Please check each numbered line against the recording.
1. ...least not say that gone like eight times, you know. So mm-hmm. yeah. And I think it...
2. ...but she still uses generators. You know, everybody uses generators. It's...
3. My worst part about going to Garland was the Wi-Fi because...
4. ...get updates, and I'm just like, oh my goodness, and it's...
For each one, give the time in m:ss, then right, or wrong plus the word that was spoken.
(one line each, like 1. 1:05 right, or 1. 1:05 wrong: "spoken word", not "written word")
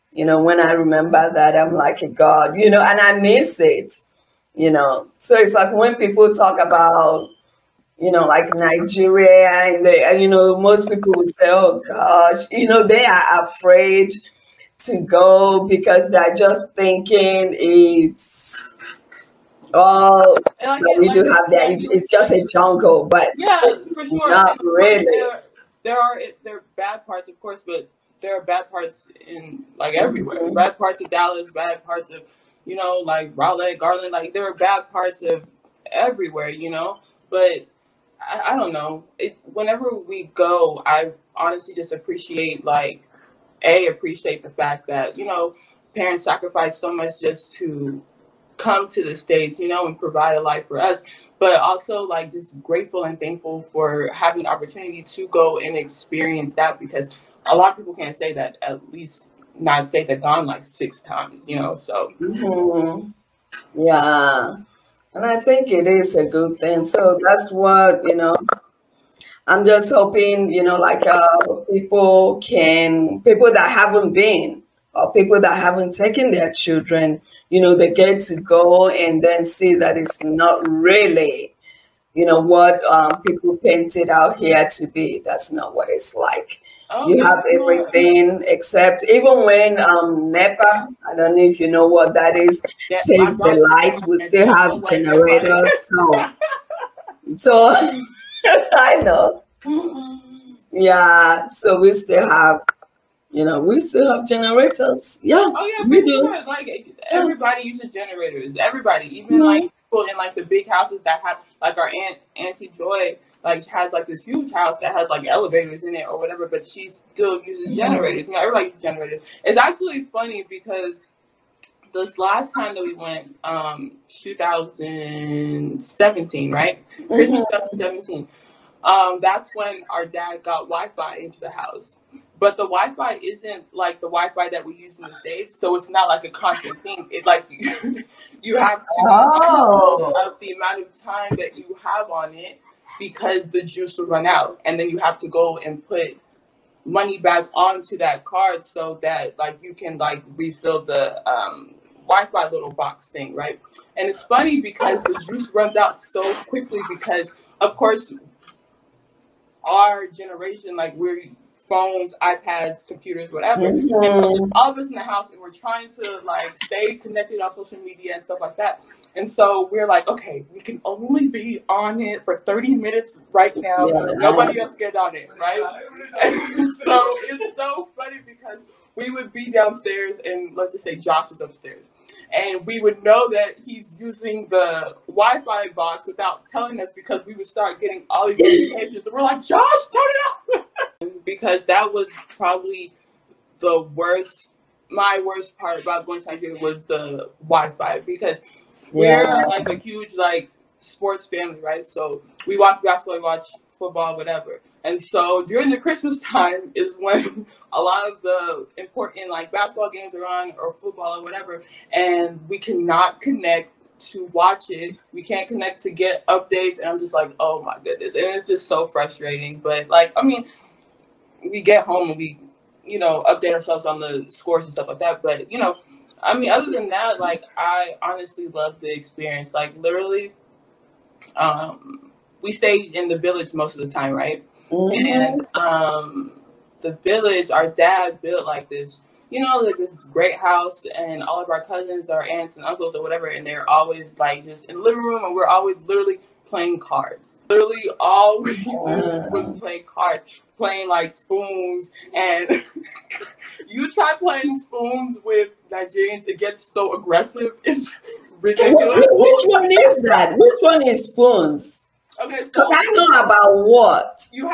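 1. 0:58 wrong: "six", not "eight"
2. 1:56 right
3. 3:14 wrong: "Nigeria", not "Garland"
4. 3:35 right.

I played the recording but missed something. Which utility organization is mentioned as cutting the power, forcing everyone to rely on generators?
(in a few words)
NEPA.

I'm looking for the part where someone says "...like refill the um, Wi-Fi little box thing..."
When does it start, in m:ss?
2:29.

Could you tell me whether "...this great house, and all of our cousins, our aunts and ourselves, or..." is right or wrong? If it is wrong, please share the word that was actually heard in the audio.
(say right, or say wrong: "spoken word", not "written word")
wrong: "uncles", not "ourselves".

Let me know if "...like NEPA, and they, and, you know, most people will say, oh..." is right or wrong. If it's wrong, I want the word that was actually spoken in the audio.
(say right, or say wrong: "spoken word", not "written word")
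wrong: "Nigeria", not "NEPA".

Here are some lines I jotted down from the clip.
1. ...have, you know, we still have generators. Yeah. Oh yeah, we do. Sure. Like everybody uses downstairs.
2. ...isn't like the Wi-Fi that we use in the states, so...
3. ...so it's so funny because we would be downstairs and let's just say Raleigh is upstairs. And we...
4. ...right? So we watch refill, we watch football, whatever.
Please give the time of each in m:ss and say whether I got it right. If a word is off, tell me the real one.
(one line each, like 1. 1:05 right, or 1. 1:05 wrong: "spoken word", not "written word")
1. 1:42 wrong: "generators", not "downstairs"
2. 2:13 right
3. 2:56 wrong: "Josh", not "Raleigh"
4. 3:21 wrong: "basketball", not "refill".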